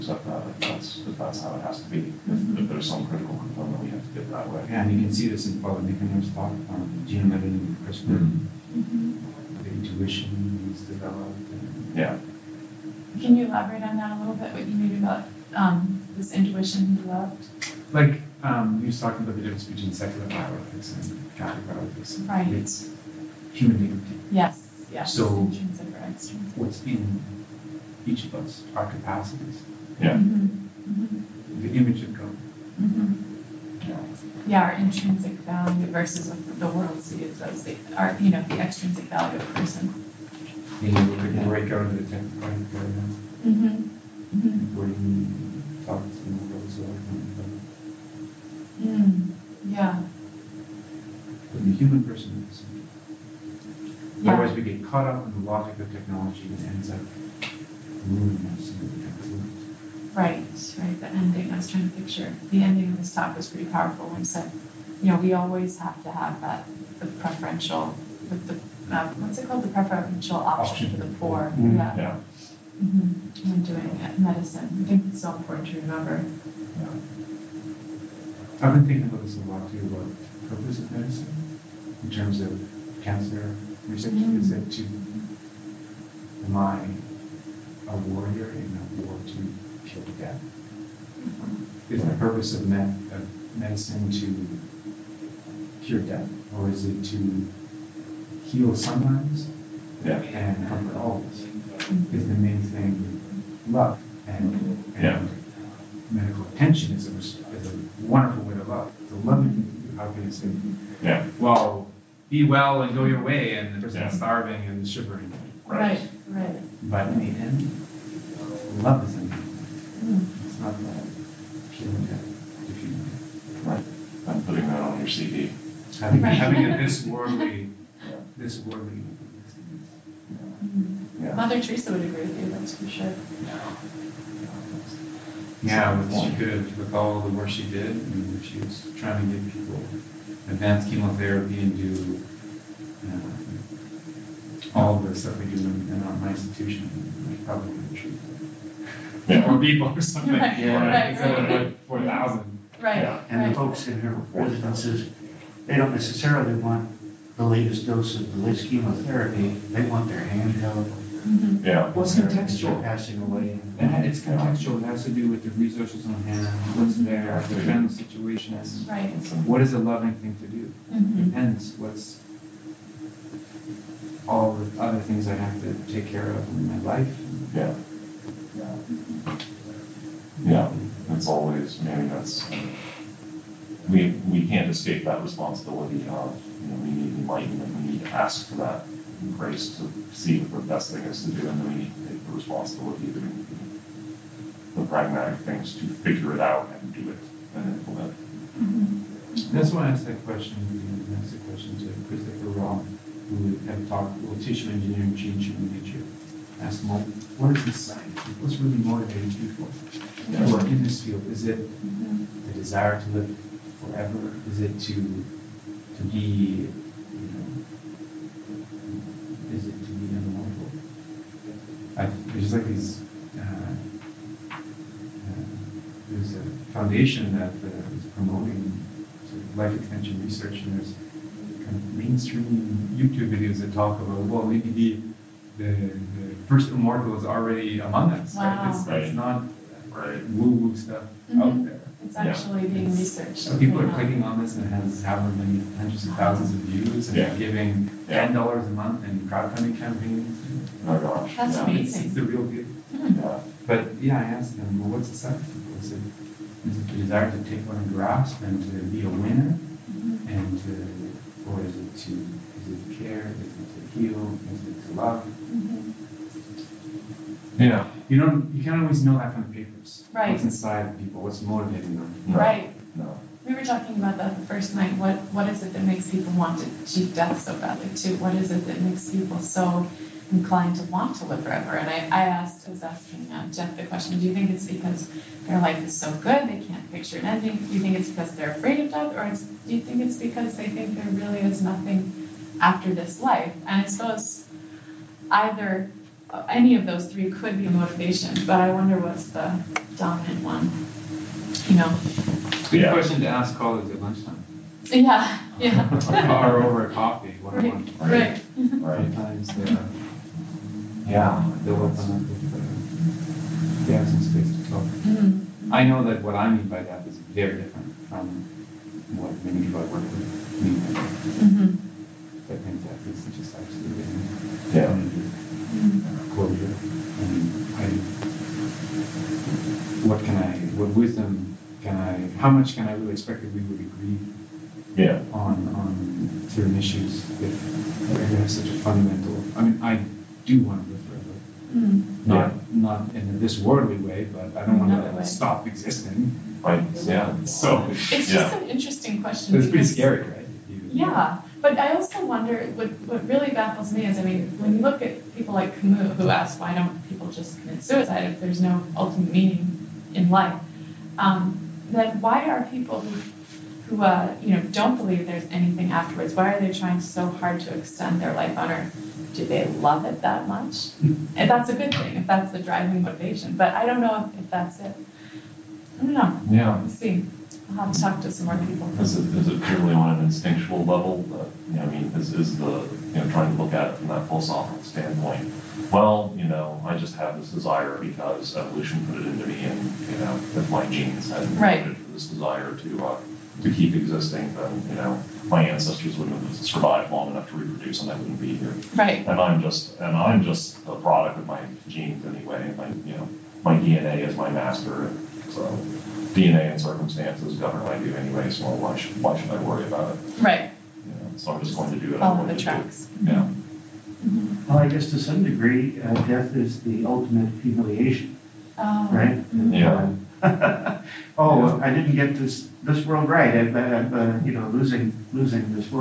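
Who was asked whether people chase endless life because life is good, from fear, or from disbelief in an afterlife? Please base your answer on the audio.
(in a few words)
Jeff.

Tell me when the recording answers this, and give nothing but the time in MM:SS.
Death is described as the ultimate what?
06:57.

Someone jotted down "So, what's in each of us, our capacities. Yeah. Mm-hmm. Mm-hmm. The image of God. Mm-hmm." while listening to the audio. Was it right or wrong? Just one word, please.
right.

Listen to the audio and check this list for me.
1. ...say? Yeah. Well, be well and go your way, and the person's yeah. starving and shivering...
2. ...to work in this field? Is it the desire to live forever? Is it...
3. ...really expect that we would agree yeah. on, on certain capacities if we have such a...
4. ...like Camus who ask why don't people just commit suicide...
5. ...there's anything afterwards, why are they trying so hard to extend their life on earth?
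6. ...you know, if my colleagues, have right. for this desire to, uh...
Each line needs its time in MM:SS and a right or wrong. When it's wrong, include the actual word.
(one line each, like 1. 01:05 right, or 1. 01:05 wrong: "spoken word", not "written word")
1. 01:50 right
2. 03:30 right
3. 05:32 wrong: "issues", not "capacities"
4. 05:55 right
5. 06:05 right
6. 06:30 wrong: "genes", not "colleagues".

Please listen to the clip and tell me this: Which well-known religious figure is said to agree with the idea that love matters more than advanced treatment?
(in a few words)
Mother Teresa.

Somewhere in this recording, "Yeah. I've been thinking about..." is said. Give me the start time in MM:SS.
01:16.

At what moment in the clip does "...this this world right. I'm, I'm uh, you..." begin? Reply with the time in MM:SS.
07:02.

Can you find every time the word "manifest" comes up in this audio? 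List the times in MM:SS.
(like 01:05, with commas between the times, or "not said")
not said.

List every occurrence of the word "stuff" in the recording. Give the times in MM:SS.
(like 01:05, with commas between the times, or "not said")
02:25, 04:00.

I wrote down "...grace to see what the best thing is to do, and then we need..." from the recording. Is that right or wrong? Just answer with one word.
right.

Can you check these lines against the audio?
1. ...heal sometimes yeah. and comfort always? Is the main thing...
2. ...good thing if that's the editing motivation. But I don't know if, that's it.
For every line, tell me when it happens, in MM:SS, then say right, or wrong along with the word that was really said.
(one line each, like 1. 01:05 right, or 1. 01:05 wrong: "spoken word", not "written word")
1. 01:38 right
2. 06:11 wrong: "driving", not "editing".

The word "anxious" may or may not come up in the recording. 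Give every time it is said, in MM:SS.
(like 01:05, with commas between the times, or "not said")
not said.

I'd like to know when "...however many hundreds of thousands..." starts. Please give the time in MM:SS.
04:05.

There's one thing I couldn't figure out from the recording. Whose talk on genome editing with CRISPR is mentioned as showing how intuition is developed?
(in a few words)
Paul Nikonen.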